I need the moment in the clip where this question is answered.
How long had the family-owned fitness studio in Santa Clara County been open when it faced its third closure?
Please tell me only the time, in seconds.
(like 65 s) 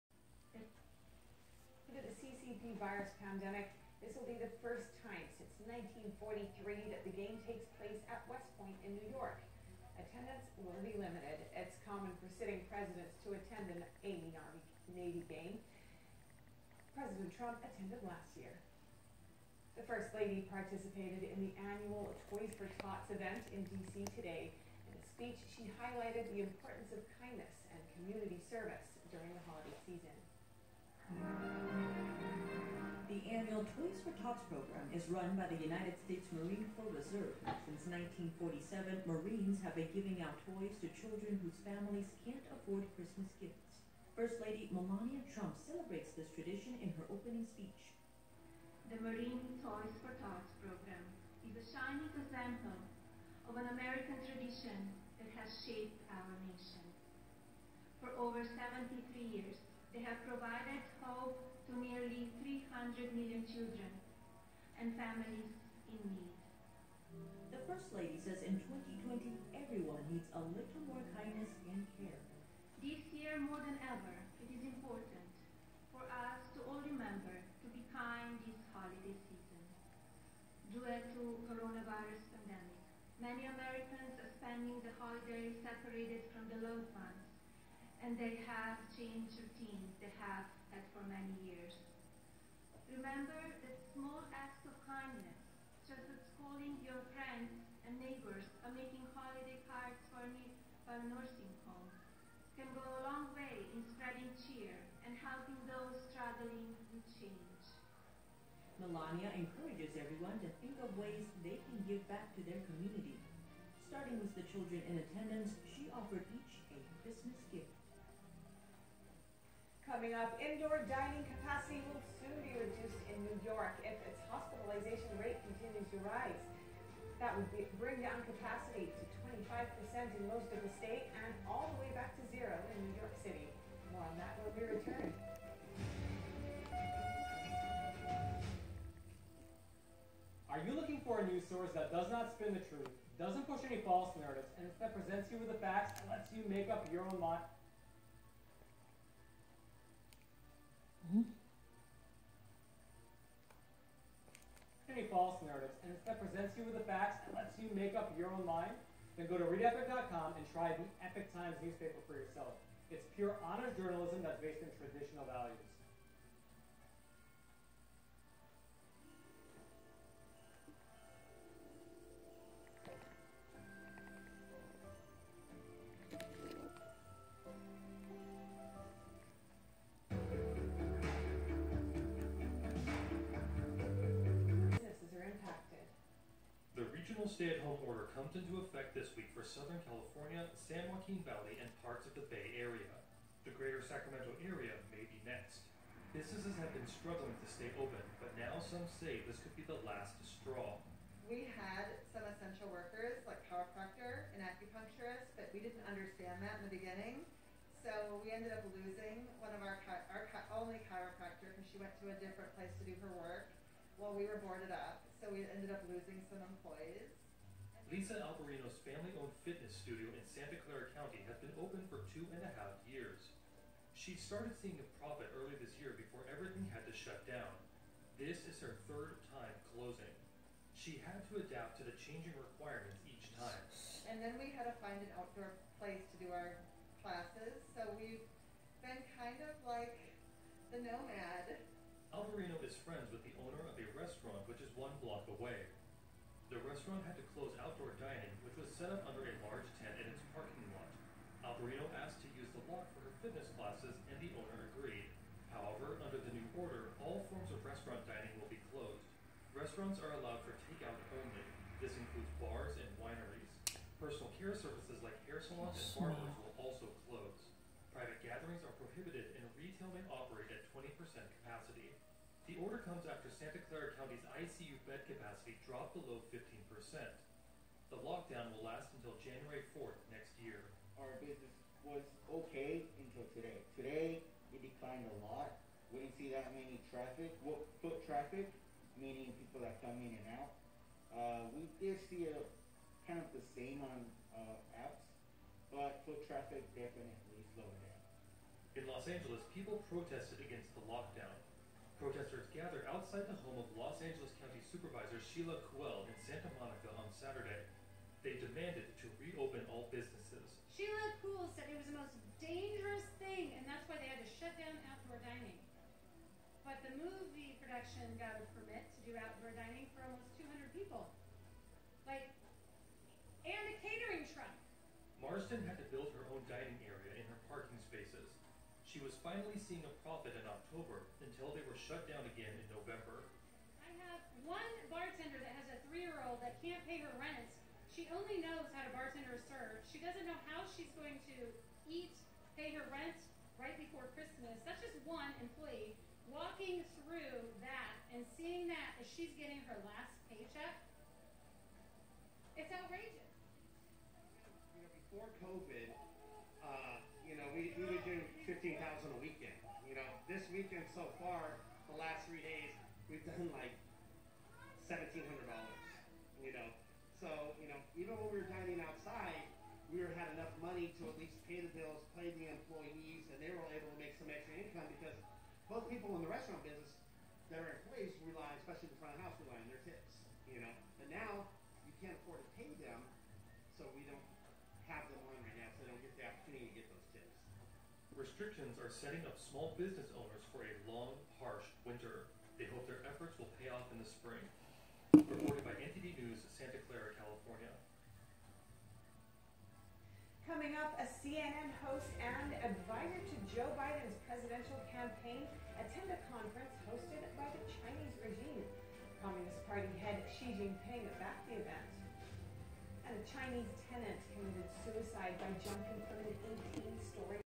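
222 s.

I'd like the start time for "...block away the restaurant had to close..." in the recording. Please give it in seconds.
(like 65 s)
245 s.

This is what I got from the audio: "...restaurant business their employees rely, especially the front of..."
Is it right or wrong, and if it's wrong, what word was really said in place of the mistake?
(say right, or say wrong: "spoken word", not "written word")
right.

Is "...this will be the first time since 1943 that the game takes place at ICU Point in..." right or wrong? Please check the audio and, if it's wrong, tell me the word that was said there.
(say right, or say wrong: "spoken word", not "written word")
wrong: "West", not "ICU".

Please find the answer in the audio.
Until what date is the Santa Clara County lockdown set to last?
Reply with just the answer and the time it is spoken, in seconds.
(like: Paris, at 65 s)
January 4, at 279 s.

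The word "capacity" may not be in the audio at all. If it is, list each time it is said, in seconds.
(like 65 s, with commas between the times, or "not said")
121 s, 128 s, 270 s, 275 s.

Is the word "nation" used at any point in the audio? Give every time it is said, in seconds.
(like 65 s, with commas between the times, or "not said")
56 s.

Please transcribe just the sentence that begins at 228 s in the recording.
This is her third time closing.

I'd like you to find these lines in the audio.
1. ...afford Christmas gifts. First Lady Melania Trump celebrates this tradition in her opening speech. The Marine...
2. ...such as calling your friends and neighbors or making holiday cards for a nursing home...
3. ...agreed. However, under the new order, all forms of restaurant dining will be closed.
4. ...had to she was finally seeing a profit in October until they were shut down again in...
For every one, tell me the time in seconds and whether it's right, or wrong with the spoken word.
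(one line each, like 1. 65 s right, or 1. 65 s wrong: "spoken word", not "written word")
1. 42 s right
2. 95 s right
3. 254 s right
4. 325 s right.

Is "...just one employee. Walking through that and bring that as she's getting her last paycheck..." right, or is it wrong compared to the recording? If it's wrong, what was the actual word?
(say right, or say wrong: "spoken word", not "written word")
wrong: "seeing", not "bring".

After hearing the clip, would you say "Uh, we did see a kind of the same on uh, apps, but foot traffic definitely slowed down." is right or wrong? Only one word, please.
right.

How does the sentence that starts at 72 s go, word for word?
This year, more than ever, it is important for us to all remember to be kind this holiday season.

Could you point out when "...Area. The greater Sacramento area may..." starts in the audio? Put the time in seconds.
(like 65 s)
192 s.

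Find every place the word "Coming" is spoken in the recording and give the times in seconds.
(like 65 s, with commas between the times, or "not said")
119 s, 400 s.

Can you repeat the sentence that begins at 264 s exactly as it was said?
Personal care services like hair salons and barbers will also close.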